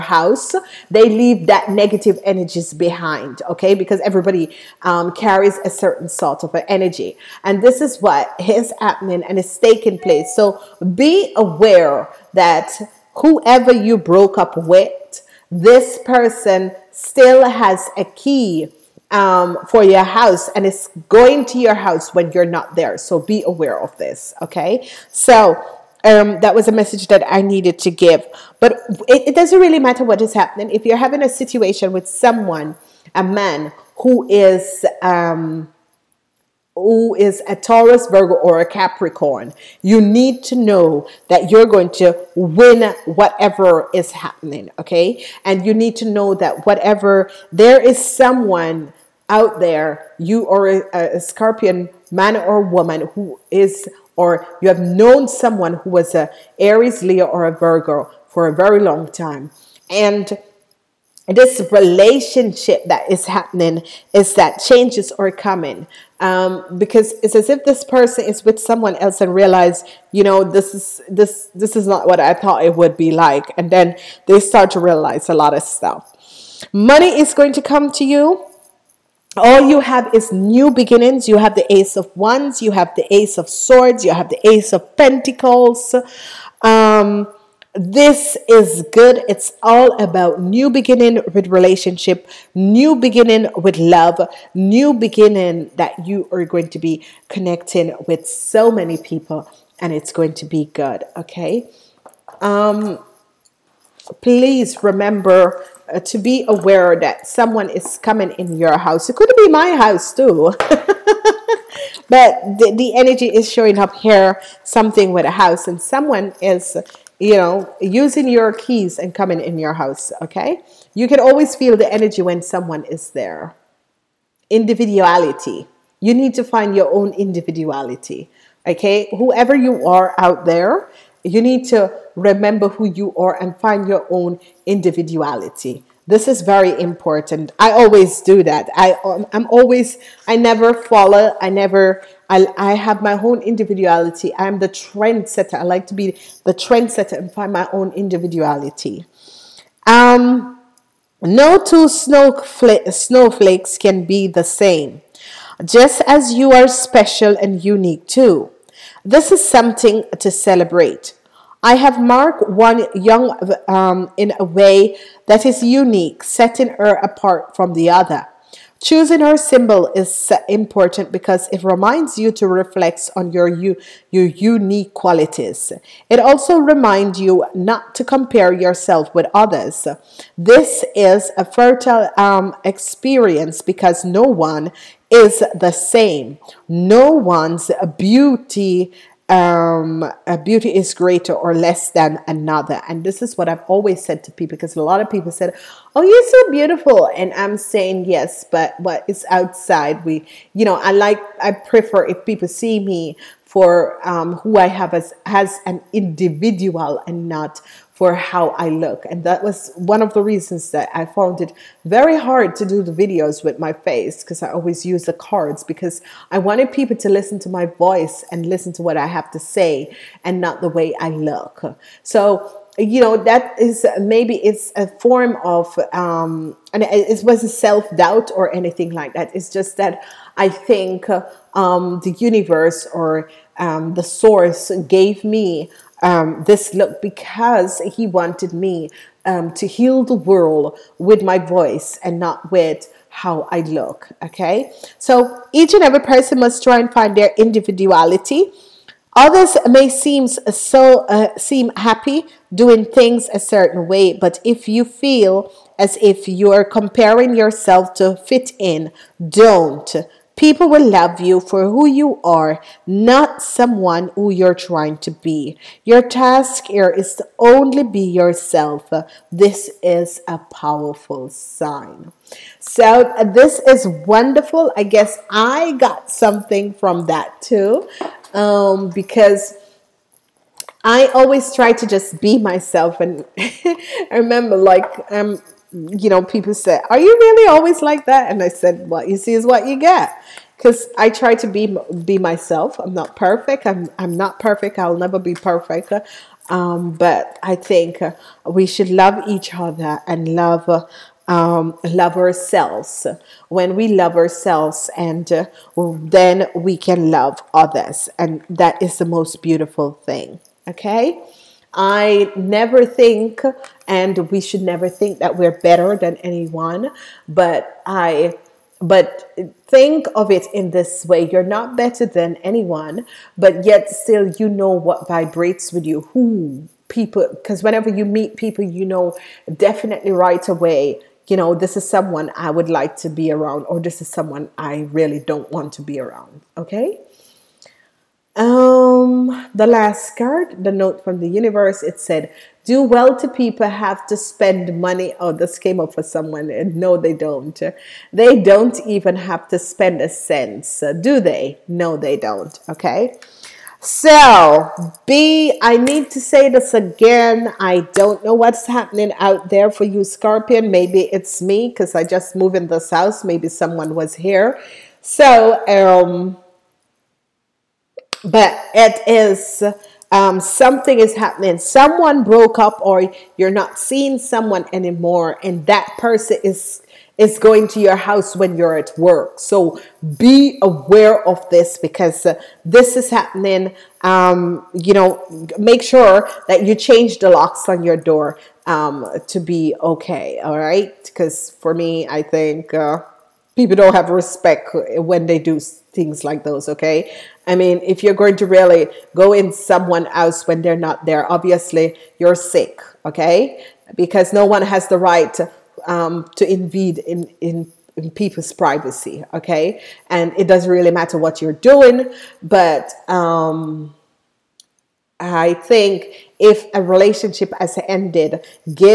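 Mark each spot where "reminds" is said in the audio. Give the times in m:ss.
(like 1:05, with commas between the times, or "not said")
2:51, 2:56.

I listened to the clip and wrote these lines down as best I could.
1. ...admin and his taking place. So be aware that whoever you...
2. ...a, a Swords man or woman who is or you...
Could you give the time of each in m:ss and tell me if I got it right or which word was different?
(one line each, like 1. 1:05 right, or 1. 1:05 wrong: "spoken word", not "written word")
1. 0:08 right
2. 0:50 wrong: "Scorpion", not "Swords".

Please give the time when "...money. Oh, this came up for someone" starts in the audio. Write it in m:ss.
5:44.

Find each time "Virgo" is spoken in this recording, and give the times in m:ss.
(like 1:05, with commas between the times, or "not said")
0:38, 0:57.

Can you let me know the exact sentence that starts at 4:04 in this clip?
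Okay, so each and every person must try and find their individuality.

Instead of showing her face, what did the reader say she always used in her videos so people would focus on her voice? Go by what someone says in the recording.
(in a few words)
The cards.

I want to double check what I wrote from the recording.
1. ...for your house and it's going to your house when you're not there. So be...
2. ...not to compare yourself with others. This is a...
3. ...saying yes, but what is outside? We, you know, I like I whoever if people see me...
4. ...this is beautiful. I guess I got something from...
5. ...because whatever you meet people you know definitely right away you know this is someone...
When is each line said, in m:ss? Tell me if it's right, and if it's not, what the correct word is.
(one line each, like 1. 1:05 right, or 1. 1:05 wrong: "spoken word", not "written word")
1. 0:19 right
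2. 2:57 right
3. 3:17 wrong: "prefer", not "whoever"
4. 4:33 wrong: "wonderful", not "beautiful"
5. 5:27 wrong: "whenever", not "whatever".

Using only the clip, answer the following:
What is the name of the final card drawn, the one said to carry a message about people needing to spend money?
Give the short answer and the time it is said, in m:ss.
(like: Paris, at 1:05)
Note from the universe, at 5:40.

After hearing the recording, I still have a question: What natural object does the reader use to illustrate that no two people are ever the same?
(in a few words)
Snowflakes.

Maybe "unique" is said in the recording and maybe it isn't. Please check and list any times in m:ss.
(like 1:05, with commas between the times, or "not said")
2:37, 2:45, 2:54.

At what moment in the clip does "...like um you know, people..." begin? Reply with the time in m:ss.
4:44.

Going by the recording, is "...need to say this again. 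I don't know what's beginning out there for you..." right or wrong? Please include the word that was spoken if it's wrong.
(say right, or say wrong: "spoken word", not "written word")
wrong: "happening", not "beginning".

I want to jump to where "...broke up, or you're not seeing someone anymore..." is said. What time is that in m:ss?
6:12.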